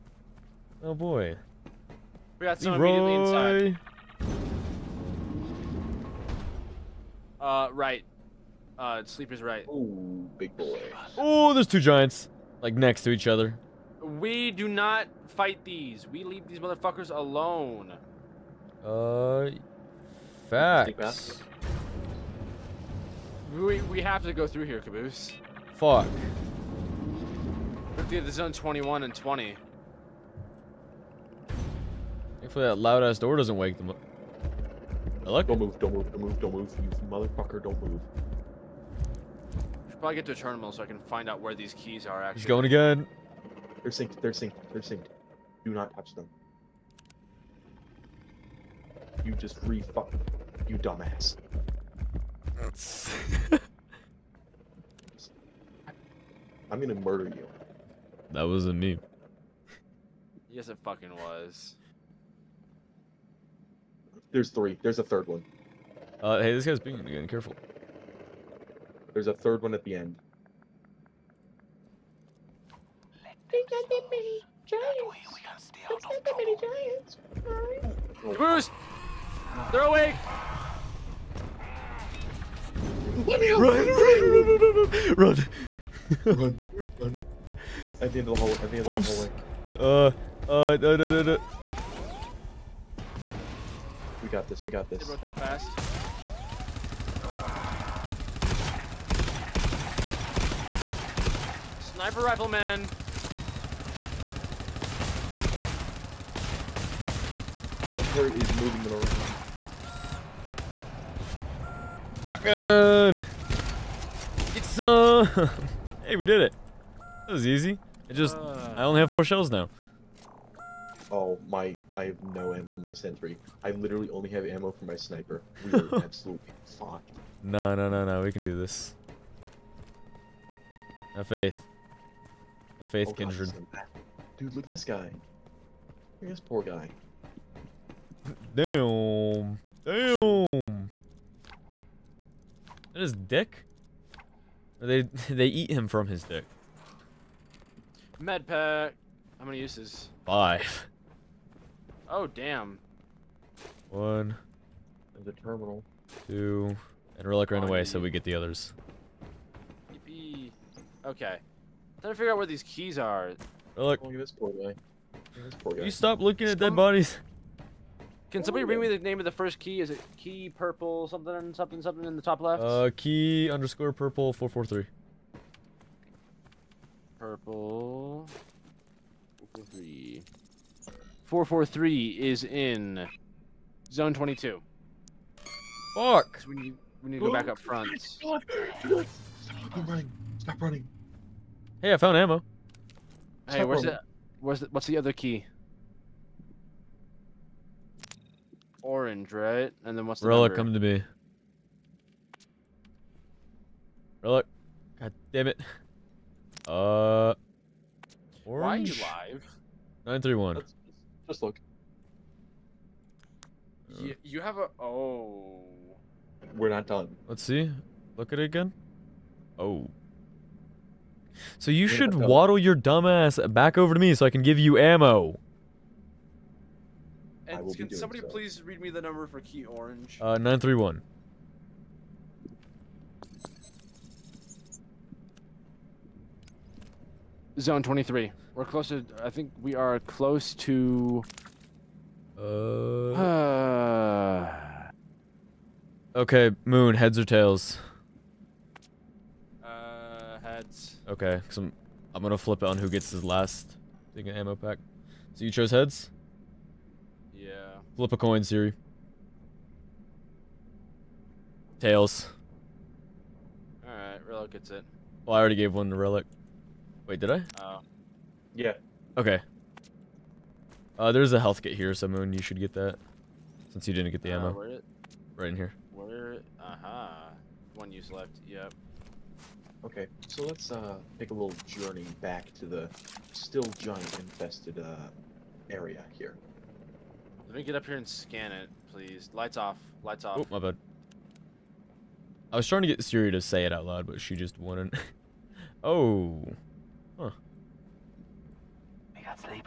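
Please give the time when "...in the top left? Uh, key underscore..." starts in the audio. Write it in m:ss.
2:52.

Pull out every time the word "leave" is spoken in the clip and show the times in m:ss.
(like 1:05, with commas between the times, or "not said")
0:16.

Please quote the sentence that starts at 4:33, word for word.
Since you didn't get the uh, ammo.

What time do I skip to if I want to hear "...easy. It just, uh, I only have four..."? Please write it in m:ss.
1:57.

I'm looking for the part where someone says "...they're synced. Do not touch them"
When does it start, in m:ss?
0:44.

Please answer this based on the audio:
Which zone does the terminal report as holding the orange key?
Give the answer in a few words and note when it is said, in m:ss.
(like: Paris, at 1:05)
Zone 23, at 3:57.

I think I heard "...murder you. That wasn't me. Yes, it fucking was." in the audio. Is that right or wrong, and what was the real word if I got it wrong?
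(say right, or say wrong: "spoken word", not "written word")
right.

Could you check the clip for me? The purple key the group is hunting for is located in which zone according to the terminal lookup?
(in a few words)
Zone 22.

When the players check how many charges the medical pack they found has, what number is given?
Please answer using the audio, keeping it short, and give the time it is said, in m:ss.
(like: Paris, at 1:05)
5, at 2:30.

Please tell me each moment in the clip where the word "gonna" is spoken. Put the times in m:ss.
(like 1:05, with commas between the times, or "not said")
0:56, 4:12.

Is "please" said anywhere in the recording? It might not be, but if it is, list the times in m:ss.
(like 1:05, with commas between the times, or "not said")
3:48, 4:48.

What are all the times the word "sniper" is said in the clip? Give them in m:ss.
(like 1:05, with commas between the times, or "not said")
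1:41, 2:04.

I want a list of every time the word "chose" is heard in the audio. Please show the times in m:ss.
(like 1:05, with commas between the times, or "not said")
4:15.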